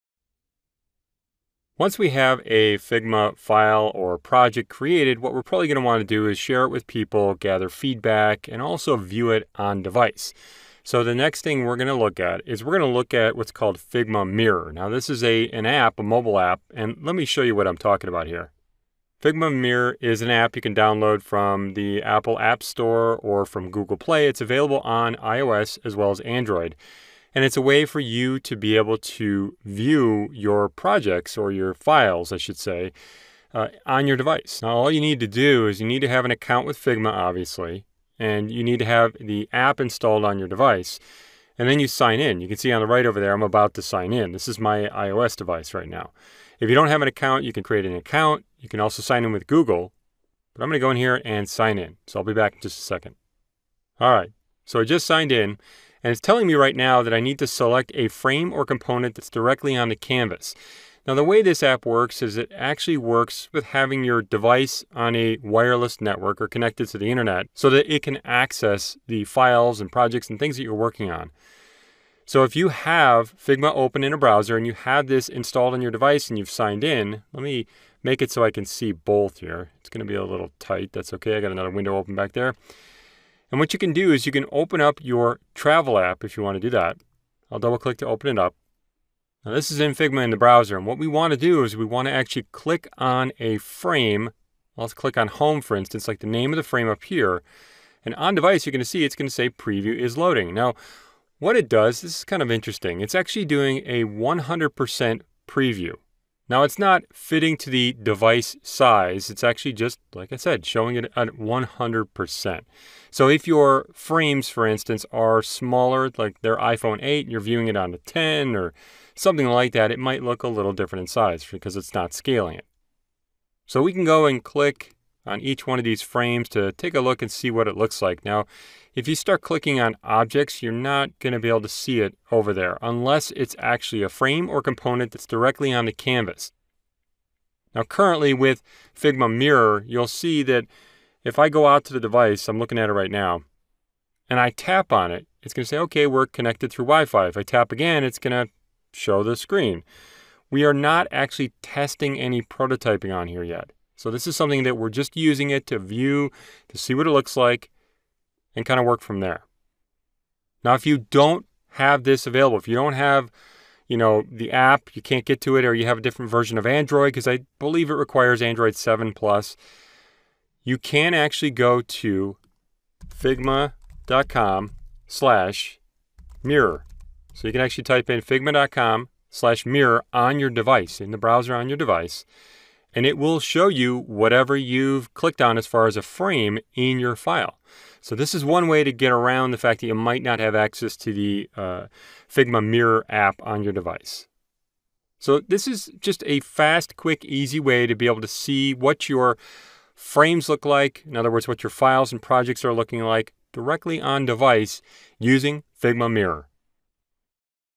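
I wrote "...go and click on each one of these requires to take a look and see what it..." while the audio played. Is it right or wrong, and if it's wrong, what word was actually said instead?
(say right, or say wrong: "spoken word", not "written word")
wrong: "frames", not "requires".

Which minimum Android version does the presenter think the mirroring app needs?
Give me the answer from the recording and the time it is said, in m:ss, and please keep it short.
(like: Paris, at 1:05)
Android 7, at 2:48.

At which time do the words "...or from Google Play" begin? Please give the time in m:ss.
0:23.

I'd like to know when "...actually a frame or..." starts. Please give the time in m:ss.
2:13.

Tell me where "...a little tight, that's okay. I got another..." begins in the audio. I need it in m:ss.
1:20.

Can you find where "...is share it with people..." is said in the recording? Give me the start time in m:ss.
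0:06.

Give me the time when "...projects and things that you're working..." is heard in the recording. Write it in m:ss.
1:09.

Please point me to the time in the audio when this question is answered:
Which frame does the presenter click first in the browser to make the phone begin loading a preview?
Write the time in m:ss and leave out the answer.
1:35.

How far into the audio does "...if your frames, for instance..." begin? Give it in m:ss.
1:53.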